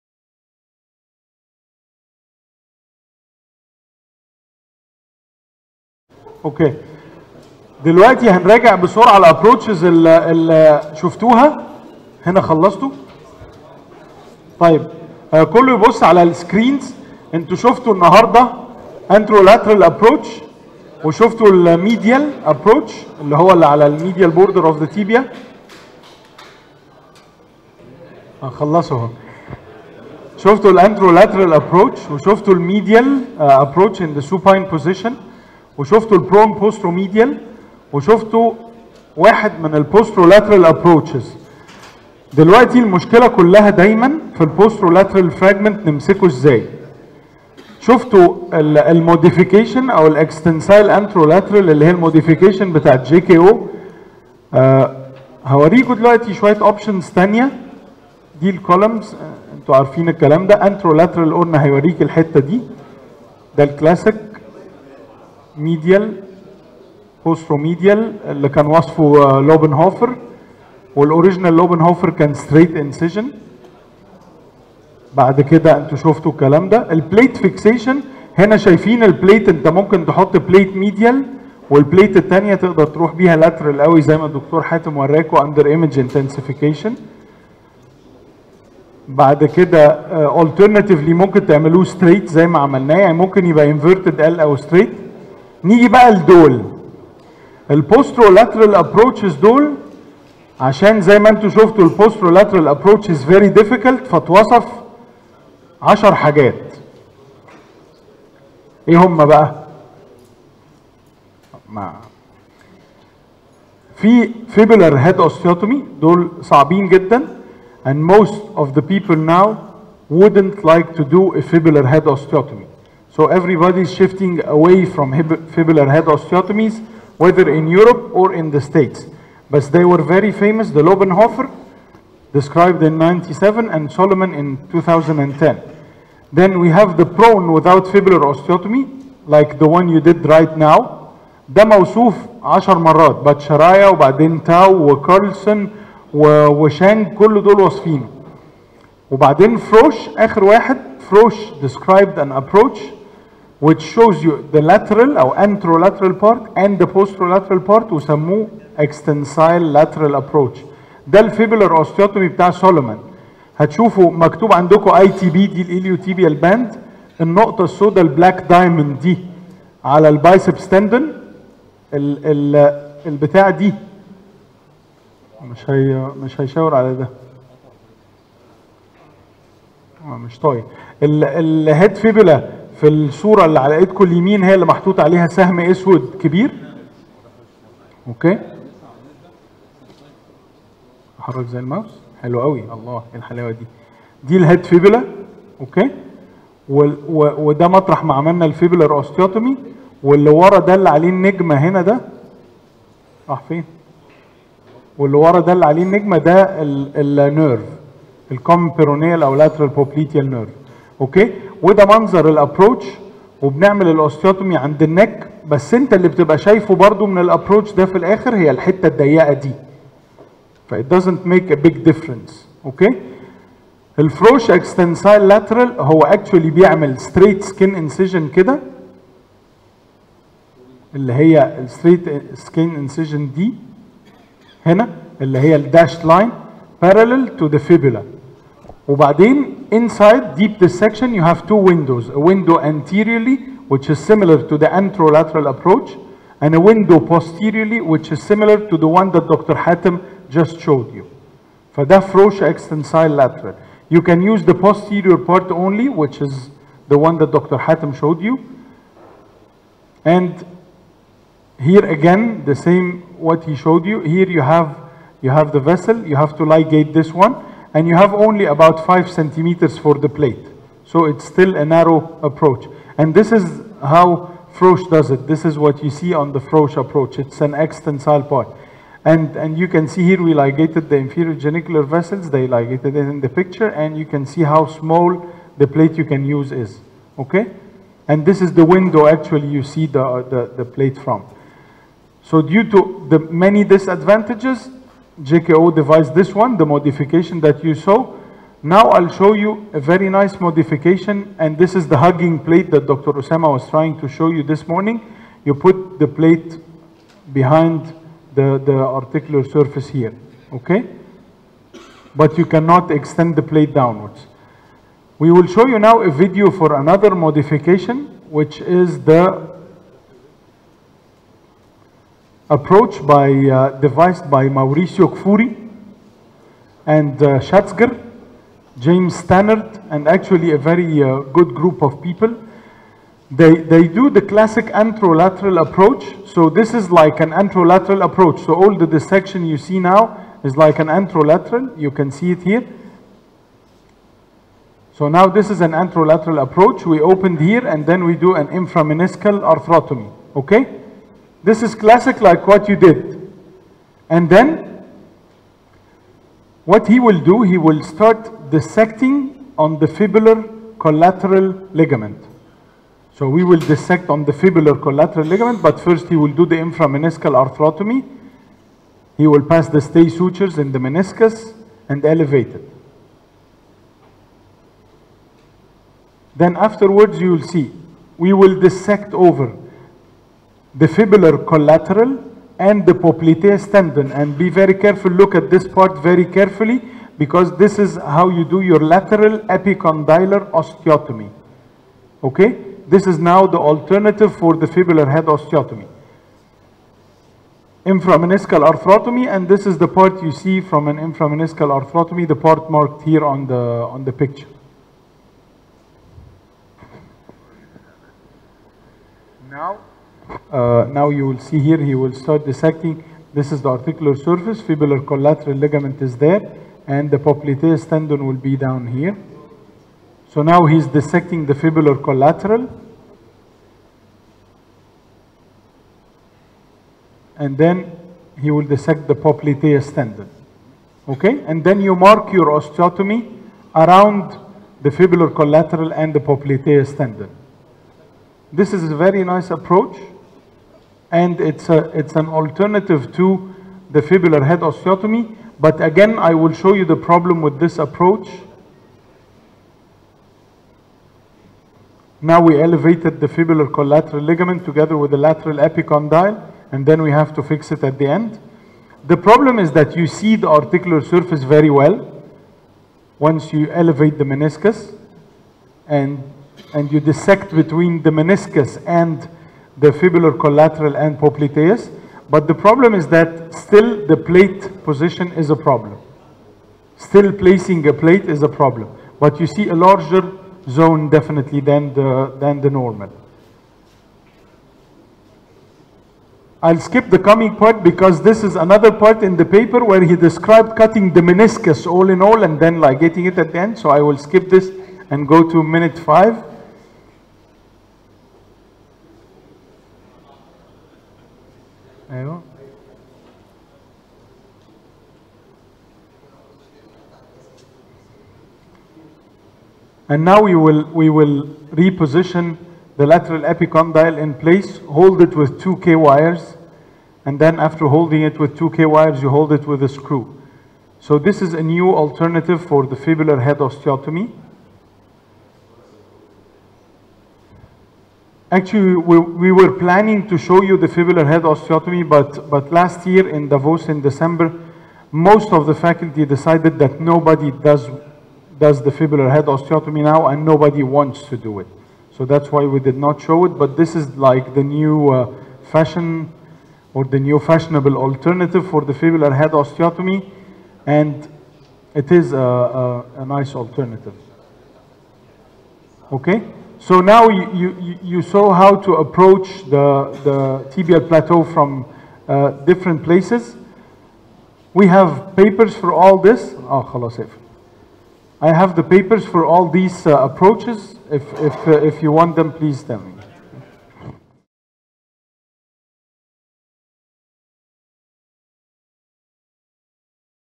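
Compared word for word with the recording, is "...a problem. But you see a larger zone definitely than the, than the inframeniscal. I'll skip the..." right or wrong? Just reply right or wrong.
wrong.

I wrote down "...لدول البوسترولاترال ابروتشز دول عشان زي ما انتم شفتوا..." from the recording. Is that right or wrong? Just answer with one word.
right.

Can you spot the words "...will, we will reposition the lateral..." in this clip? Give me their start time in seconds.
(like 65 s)
510 s.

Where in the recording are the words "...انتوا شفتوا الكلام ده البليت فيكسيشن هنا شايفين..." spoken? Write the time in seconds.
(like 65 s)
75 s.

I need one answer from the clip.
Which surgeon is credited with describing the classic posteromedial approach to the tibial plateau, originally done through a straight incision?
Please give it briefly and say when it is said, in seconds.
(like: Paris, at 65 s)
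Lobenhofer, at 69 s.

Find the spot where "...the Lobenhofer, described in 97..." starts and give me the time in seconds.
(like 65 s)
130 s.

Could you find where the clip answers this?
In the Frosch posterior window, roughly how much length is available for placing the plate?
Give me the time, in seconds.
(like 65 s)
268 s.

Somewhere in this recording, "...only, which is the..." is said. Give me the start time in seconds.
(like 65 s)
255 s.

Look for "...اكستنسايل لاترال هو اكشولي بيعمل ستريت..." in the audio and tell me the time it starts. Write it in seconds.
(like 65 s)
224 s.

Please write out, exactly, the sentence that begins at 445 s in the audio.
But again, I will show you the problem with this approach.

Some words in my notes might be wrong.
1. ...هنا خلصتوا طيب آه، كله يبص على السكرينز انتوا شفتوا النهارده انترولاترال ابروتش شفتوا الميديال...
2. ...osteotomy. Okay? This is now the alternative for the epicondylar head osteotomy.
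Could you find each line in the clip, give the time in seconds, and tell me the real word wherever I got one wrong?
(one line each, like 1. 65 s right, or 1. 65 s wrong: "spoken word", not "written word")
1. 12 s wrong: "وشفتوا", not "شفتوا"
2. 390 s wrong: "fibular", not "epicondylar".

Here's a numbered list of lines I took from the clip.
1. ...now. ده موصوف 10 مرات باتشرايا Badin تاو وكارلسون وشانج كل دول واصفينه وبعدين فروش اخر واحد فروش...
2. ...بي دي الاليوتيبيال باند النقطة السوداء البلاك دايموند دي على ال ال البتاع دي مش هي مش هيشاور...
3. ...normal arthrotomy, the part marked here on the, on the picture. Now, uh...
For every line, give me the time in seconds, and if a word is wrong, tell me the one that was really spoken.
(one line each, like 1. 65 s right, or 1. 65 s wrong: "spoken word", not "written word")
1. 140 s right
2. 165 s right
3. 400 s wrong: "inframeniscal", not "normal".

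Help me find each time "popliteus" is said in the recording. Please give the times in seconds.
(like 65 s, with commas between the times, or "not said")
382 s, 417 s, 429 s, 436 s, 471 s.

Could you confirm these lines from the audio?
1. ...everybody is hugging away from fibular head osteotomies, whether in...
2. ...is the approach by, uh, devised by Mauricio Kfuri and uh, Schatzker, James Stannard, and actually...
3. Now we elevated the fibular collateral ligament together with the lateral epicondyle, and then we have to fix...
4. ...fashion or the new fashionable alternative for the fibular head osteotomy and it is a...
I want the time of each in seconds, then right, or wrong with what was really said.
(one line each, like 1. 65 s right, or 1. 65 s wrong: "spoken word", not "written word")
1. 123 s wrong: "shifting", not "hugging"
2. 318 s right
3. 452 s right
4. 545 s right.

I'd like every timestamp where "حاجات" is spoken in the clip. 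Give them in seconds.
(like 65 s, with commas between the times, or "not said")
106 s.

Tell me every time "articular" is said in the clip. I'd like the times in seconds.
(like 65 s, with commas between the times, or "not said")
308 s, 413 s, 460 s.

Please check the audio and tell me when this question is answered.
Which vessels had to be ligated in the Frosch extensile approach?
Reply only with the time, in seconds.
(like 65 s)
280 s.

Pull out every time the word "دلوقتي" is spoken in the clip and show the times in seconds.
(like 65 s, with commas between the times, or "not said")
7 s, 42 s, 55 s.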